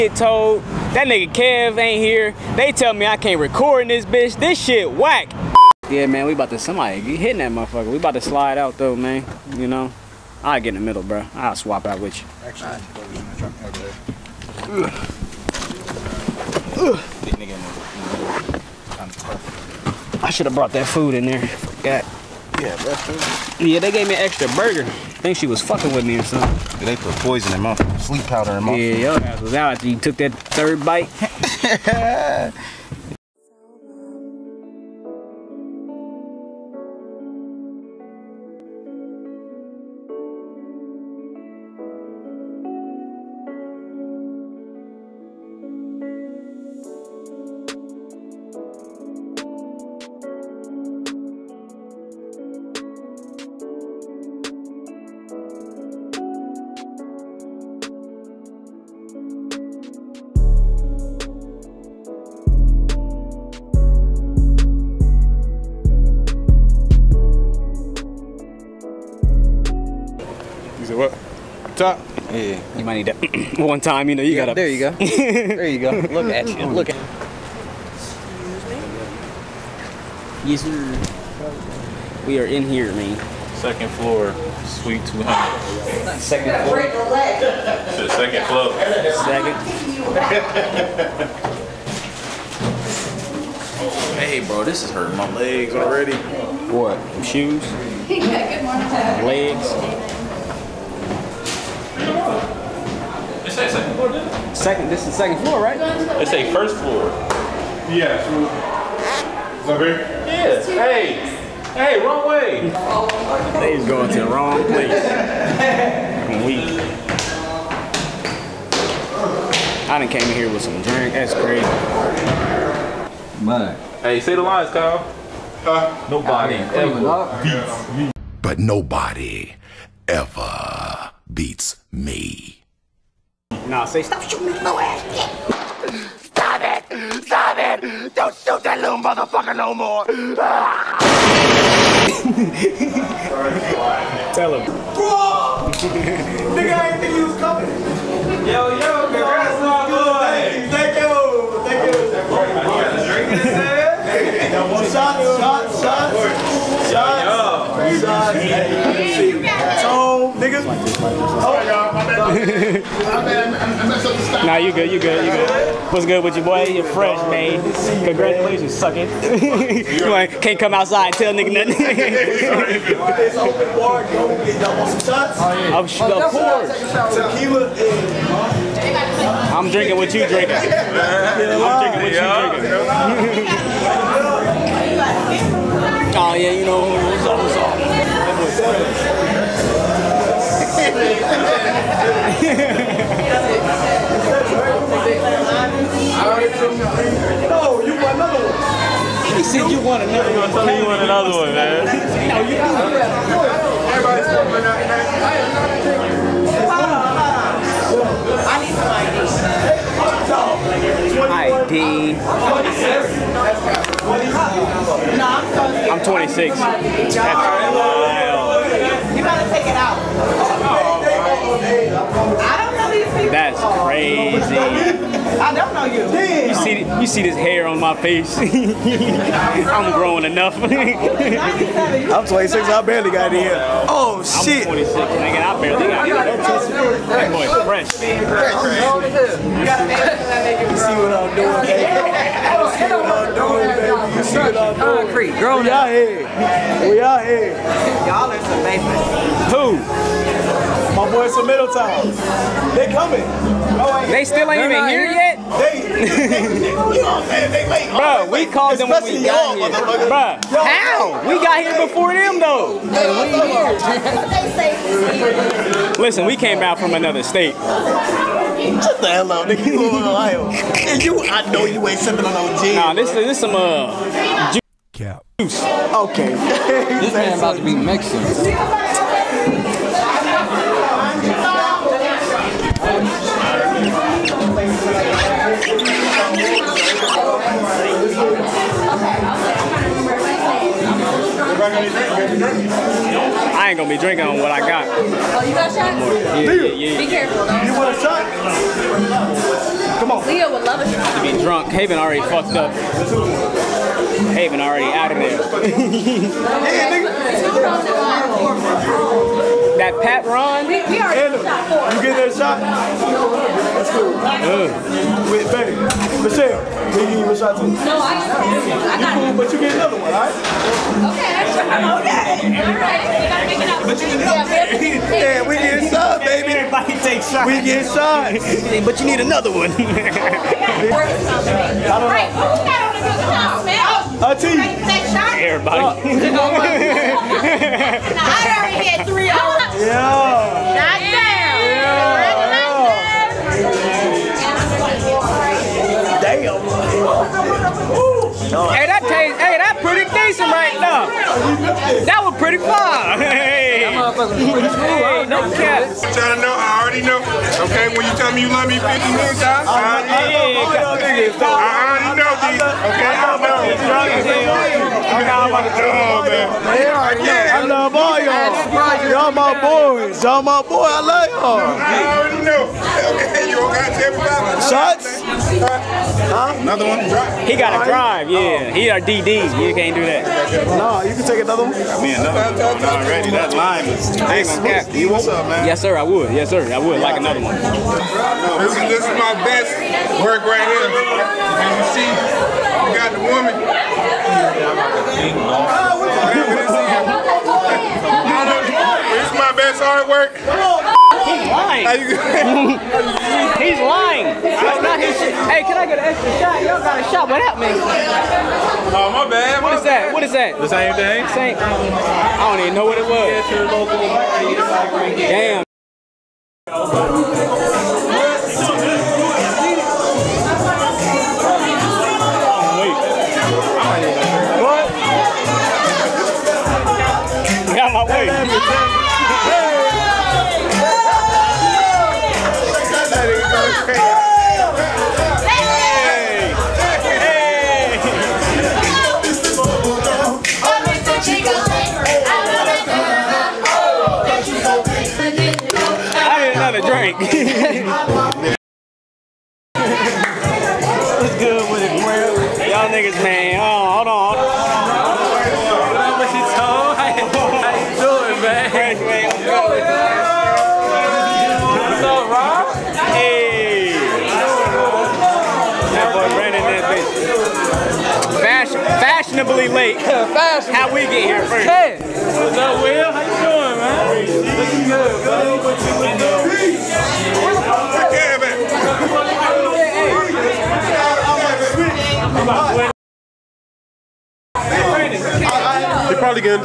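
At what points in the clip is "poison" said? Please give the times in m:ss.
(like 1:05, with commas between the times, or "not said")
0:27.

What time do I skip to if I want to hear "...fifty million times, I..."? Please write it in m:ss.
5:58.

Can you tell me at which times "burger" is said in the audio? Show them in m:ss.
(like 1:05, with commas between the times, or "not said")
0:24.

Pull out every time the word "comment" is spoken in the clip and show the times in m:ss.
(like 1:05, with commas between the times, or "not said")
not said.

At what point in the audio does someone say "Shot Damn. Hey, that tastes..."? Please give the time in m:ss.
5:48.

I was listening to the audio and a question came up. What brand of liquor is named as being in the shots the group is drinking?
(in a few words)
Patron.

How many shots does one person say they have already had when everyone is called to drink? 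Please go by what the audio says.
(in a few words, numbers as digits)
3.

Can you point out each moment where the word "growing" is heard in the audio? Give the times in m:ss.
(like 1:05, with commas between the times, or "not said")
3:49, 4:05.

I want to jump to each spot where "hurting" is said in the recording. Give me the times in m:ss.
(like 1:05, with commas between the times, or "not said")
1:34.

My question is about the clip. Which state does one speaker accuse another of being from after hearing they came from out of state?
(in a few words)
Ohio.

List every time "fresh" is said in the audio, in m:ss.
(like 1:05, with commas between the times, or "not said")
2:46, 3:57.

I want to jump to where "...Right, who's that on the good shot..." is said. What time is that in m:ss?
5:30.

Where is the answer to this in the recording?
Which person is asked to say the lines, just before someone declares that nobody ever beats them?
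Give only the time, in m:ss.
2:04.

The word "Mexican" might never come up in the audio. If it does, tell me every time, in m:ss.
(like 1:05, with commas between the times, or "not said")
4:37.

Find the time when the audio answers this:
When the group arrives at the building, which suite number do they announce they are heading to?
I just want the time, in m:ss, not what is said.
1:24.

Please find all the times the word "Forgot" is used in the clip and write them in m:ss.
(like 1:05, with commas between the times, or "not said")
0:21.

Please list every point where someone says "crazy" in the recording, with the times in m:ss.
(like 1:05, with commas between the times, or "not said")
2:01, 3:43.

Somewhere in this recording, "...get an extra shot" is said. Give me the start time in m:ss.
6:45.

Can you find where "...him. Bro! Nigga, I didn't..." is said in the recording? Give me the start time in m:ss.
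2:24.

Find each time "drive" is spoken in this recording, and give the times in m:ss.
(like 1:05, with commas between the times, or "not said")
6:17.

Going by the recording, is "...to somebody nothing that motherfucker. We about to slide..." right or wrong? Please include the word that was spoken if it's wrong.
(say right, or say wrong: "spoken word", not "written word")
wrong: "hitting", not "nothing".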